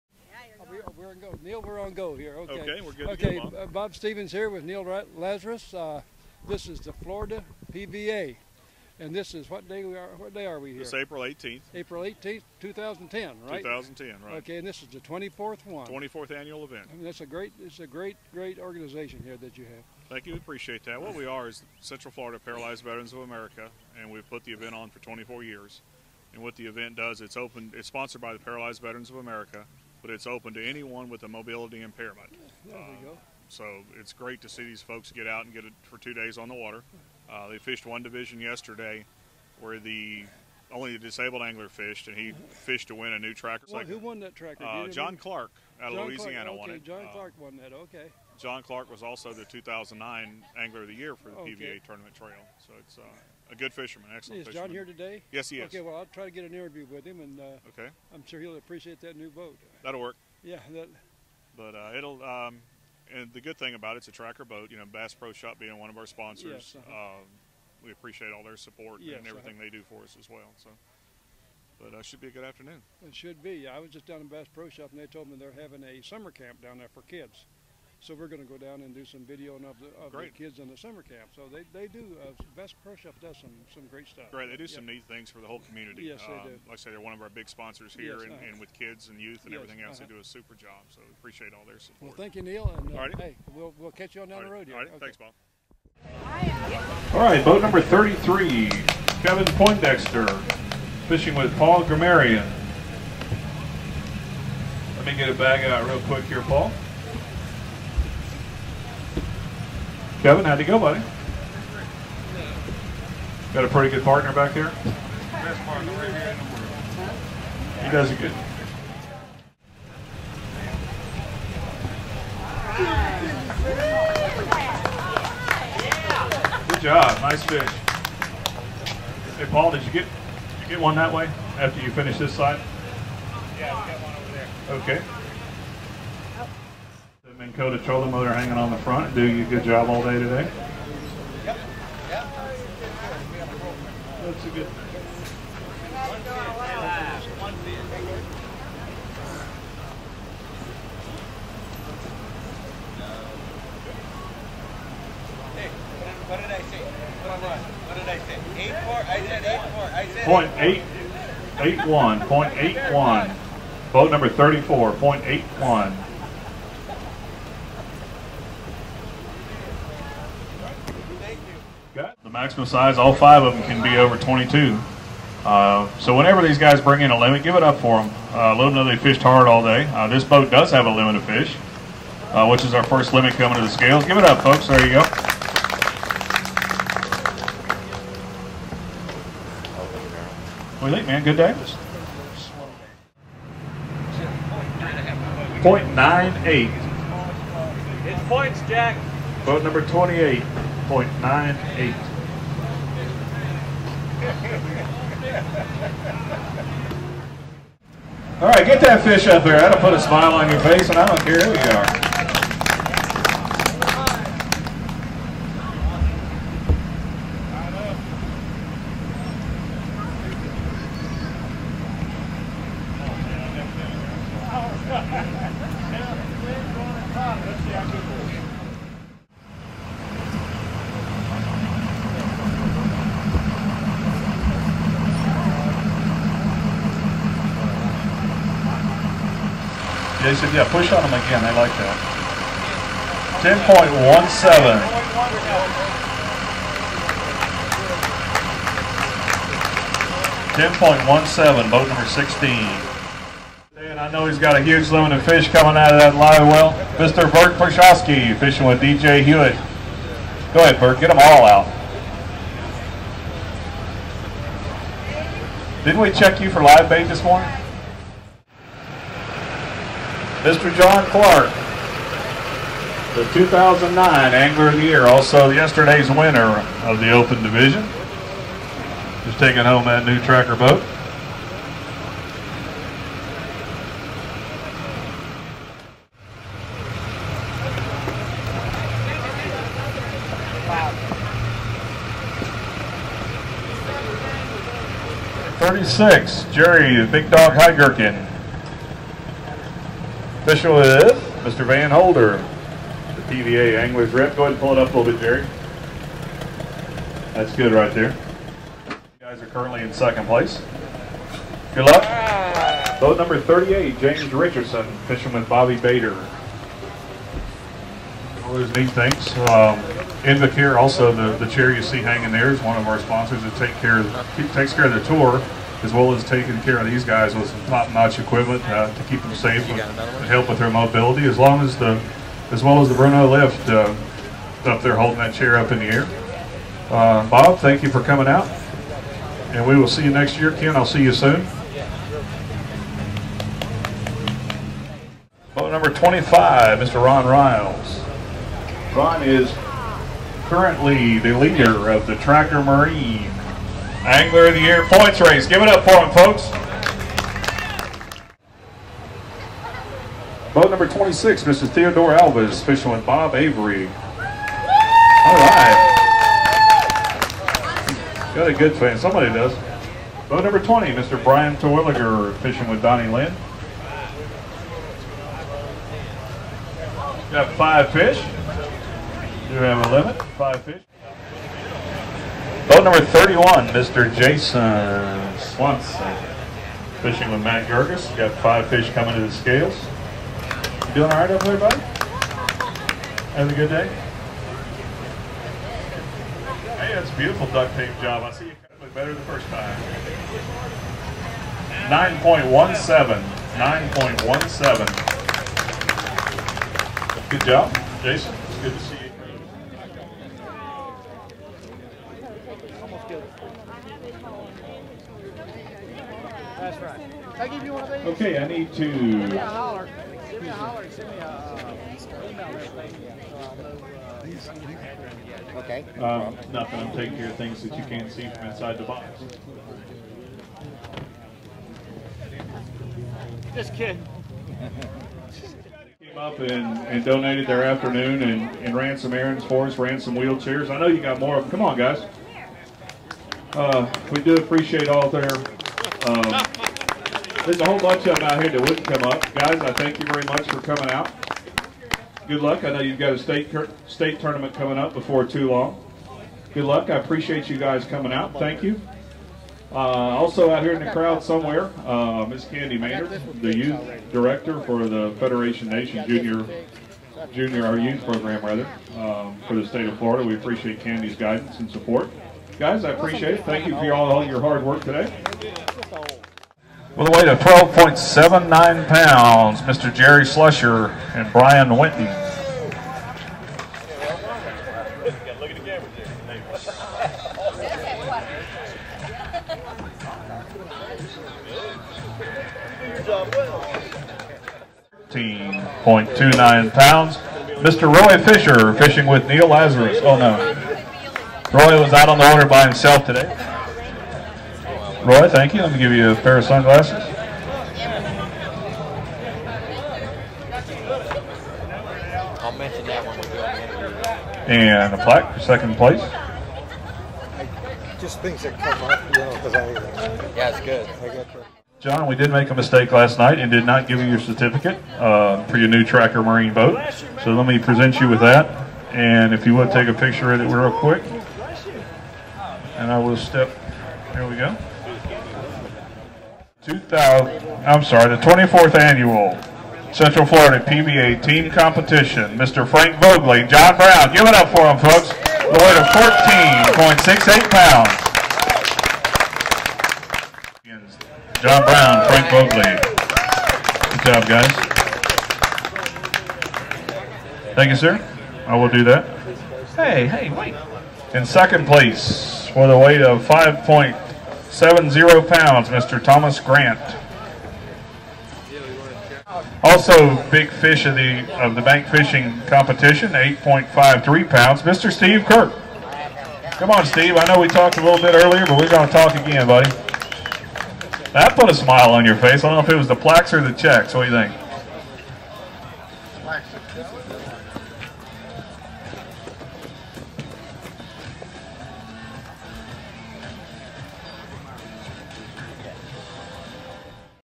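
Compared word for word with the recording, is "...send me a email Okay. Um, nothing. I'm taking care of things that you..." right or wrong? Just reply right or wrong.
right.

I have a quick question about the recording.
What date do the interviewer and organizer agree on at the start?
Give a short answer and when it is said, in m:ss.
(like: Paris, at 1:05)
April 18th, 2010, at 0:11.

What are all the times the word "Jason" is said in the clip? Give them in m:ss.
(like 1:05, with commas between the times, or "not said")
6:24, 6:48.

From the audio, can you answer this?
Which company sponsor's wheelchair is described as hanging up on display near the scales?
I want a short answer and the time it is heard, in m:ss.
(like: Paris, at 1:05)
Invacare, at 5:20.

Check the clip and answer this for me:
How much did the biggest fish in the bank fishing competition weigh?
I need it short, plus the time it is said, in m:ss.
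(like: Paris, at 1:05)
8.53 pounds, at 9:33.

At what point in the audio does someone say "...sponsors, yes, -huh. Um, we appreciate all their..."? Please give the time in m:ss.
1:06.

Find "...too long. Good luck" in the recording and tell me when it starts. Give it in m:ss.
7:35.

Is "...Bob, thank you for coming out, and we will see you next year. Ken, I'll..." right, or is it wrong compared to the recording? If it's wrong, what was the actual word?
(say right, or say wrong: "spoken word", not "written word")
right.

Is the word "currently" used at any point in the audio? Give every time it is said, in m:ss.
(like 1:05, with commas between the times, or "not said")
5:09, 5:50.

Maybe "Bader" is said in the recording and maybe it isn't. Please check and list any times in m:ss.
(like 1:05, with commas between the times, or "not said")
5:15.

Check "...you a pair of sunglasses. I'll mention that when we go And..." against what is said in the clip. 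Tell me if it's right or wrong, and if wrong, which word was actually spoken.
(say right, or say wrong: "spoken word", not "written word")
right.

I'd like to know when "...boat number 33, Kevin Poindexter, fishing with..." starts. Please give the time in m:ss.
1:37.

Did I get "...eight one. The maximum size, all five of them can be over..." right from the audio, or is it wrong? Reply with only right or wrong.
right.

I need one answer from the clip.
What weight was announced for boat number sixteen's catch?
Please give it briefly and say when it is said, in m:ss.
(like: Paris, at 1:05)
10.17, at 4:10.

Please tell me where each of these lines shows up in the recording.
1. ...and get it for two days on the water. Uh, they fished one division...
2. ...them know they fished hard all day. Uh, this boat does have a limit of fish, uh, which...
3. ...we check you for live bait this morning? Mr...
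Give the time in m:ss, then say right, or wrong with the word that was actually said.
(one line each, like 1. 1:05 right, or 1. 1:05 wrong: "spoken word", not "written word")
1. 0:35 right
2. 2:58 right
3. 4:25 right.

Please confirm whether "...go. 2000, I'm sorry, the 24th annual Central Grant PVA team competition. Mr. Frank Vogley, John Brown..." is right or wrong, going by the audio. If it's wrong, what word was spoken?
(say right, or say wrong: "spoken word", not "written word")
wrong: "Florida", not "Grant".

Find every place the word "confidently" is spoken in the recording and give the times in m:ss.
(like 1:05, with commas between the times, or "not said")
not said.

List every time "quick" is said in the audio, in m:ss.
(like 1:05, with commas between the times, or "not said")
1:46, 8:50.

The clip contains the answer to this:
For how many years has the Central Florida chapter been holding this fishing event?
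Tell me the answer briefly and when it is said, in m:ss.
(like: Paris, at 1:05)
24, at 0:24.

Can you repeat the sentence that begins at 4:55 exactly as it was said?
Thirty-six, Jerry Big Dog high Heigerkin.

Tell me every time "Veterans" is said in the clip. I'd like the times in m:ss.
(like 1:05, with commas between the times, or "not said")
0:22, 0:28.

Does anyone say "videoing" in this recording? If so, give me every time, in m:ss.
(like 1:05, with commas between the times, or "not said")
1:19.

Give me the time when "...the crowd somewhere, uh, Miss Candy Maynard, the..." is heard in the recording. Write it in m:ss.
7:40.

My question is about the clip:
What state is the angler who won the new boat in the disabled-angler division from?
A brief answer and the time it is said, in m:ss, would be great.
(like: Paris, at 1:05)
Louisiana, at 0:46.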